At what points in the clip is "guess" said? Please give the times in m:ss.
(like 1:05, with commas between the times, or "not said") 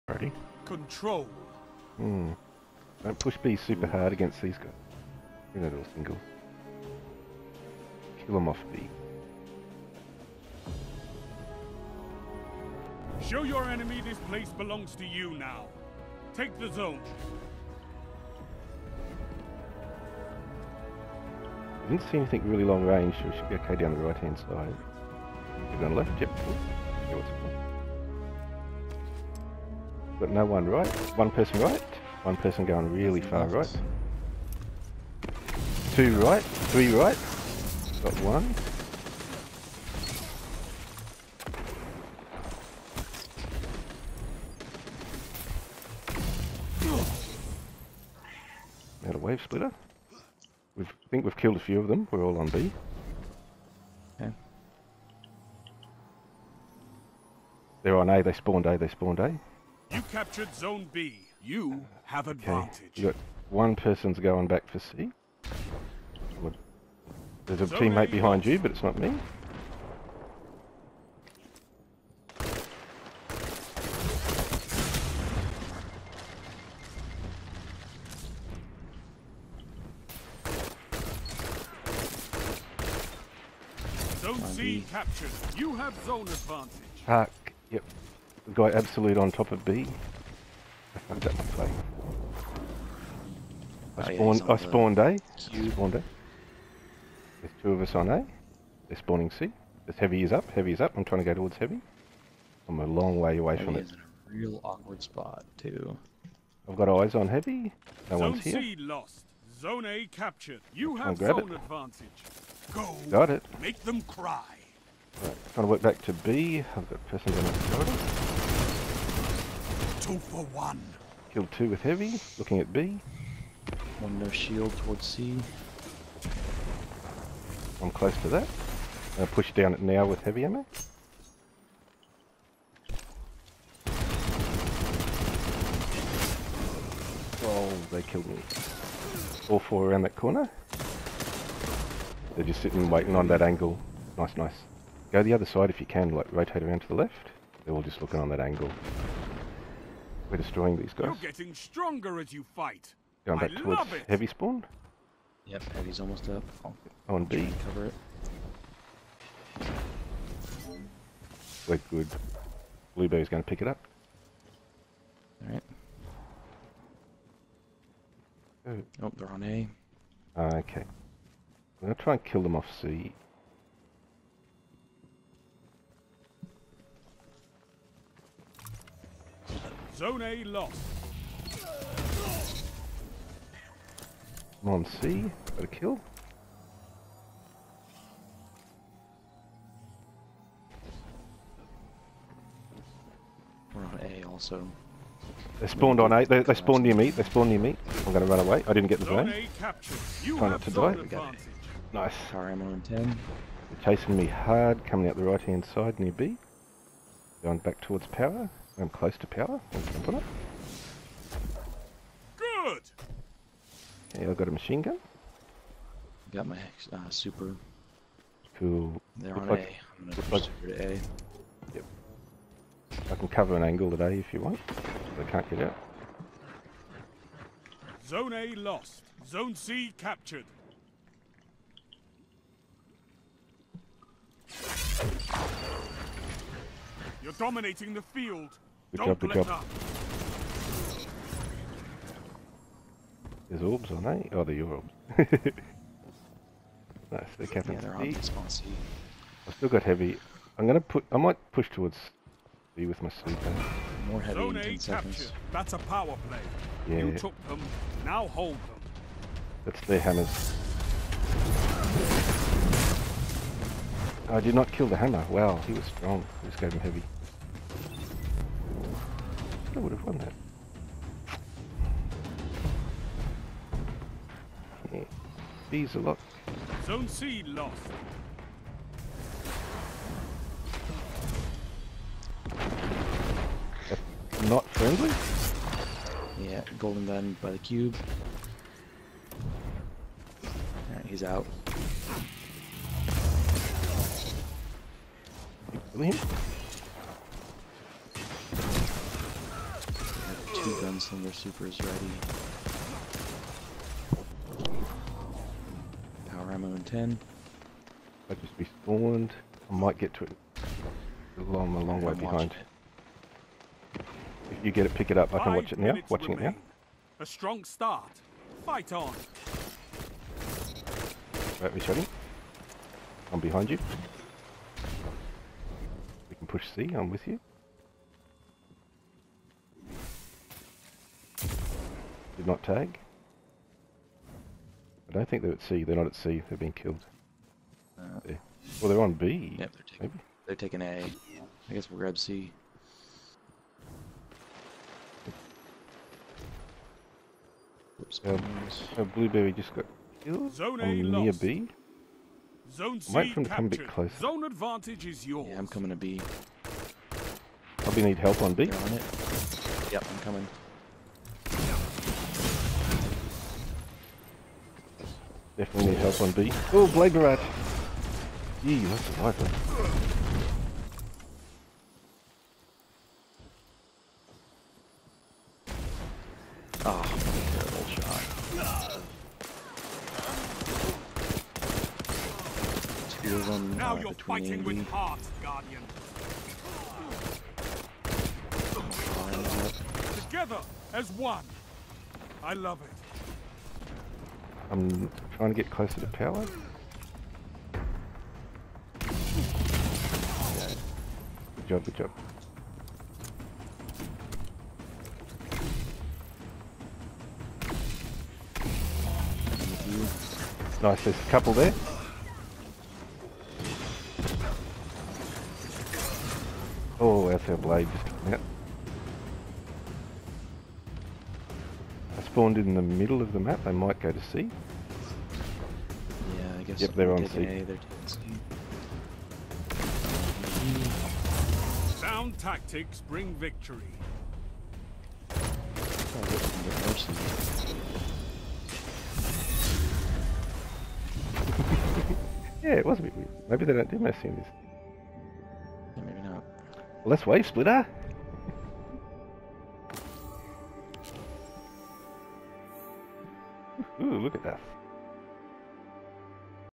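5:41, 7:06.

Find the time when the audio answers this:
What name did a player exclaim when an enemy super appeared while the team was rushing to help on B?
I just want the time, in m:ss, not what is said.
6:06.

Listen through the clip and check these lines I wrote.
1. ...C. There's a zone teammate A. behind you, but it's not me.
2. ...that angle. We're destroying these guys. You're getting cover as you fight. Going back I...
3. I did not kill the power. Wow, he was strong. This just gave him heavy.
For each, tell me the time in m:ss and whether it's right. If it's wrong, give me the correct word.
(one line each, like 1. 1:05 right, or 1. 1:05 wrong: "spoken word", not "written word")
1. 1:04 right
2. 2:28 wrong: "stronger", not "cover"
3. 4:24 wrong: "hammer", not "power".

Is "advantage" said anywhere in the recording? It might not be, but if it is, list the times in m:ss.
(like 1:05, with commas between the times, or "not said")
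1:02, 1:26, 1:51, 5:54.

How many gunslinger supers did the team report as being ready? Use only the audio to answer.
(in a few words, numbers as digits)
2.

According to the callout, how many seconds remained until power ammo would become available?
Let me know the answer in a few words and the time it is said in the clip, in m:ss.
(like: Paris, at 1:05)
10, at 5:06.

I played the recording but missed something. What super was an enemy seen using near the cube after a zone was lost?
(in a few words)
Golden gun.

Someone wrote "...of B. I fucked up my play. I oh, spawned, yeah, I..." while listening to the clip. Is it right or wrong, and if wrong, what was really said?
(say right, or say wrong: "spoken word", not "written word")
right.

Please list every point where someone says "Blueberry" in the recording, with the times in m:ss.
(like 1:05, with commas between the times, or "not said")
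2:42, 5:49.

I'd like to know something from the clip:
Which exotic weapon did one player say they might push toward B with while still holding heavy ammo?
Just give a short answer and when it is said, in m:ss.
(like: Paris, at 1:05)
Sleeper, at 4:13.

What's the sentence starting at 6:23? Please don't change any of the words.
heals uh, on now you're fighting with heart, Guardian.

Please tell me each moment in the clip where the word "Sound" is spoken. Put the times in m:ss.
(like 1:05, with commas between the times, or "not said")
7:11.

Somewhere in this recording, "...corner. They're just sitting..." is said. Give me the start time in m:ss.
2:20.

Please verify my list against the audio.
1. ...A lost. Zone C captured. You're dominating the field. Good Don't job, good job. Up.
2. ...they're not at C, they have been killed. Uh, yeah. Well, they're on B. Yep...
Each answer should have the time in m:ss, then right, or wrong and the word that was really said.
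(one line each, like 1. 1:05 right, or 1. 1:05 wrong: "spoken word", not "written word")
1. 3:48 right
2. 5:35 right.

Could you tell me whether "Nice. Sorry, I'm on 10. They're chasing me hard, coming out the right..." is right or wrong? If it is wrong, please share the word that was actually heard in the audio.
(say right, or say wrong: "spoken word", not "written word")
right.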